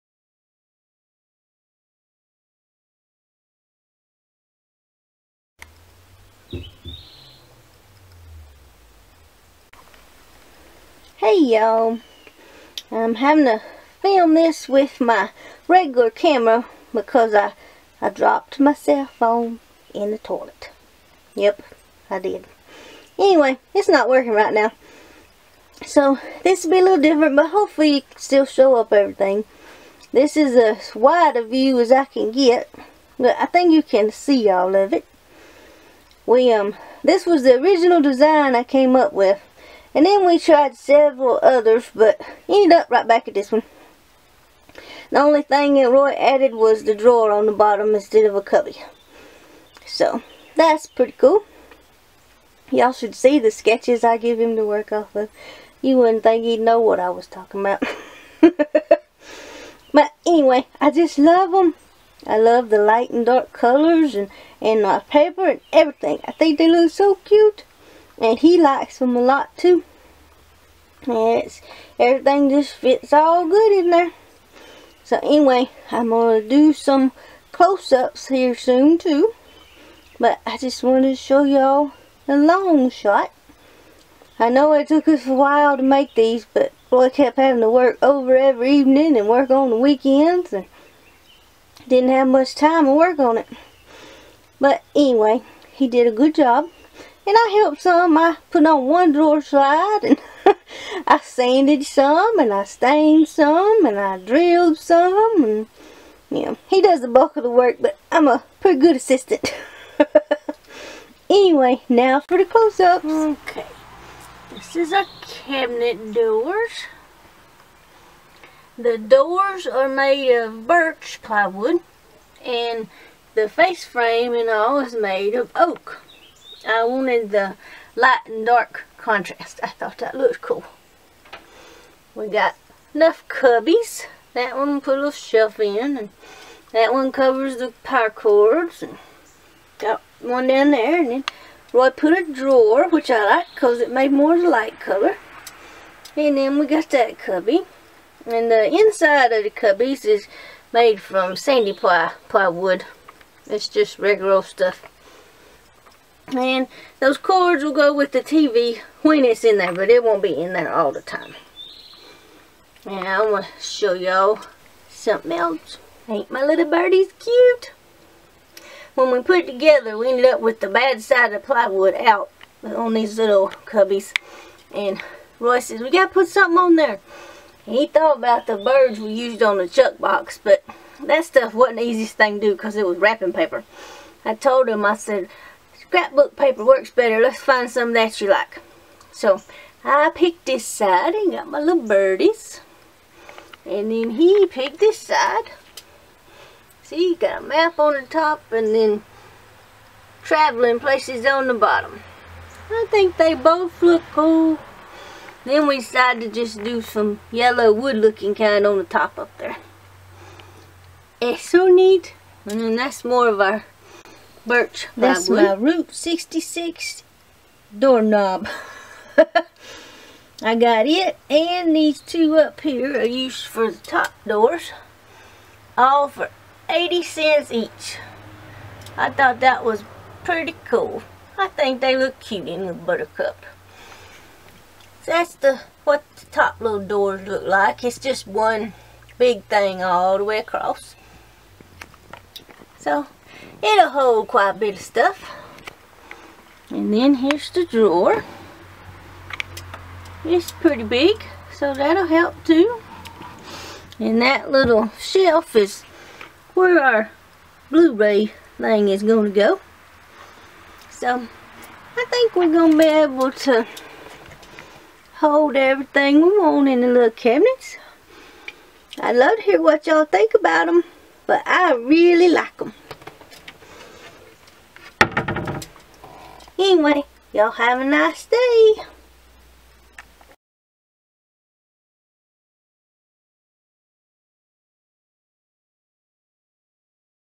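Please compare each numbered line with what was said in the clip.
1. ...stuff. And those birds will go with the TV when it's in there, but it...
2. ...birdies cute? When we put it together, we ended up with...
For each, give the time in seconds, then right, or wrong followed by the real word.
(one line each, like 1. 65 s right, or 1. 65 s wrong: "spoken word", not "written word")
1. 154 s wrong: "cords", not "birds"
2. 166 s right.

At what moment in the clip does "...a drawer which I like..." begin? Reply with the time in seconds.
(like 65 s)
142 s.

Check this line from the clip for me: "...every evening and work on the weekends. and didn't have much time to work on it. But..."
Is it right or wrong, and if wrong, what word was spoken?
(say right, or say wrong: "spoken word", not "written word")
right.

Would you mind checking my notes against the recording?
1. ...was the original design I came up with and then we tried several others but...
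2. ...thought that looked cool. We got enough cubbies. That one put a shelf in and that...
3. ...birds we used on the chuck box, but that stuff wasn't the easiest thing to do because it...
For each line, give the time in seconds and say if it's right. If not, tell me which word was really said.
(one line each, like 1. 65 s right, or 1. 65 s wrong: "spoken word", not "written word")
1. 37 s right
2. 129 s right
3. 178 s right.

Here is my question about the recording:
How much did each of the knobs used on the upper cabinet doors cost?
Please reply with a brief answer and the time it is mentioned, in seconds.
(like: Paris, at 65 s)
80 cents, at 226 s.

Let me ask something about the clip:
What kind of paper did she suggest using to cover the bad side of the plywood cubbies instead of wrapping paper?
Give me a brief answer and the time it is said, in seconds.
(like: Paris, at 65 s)
Scrapbook paper, at 185 s.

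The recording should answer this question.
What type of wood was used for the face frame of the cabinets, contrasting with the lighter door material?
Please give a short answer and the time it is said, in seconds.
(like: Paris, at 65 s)
Oak, at 125 s.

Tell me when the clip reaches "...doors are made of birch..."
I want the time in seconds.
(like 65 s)
118 s.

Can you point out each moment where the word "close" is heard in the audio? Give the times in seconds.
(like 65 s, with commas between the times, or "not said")
77 s, 112 s.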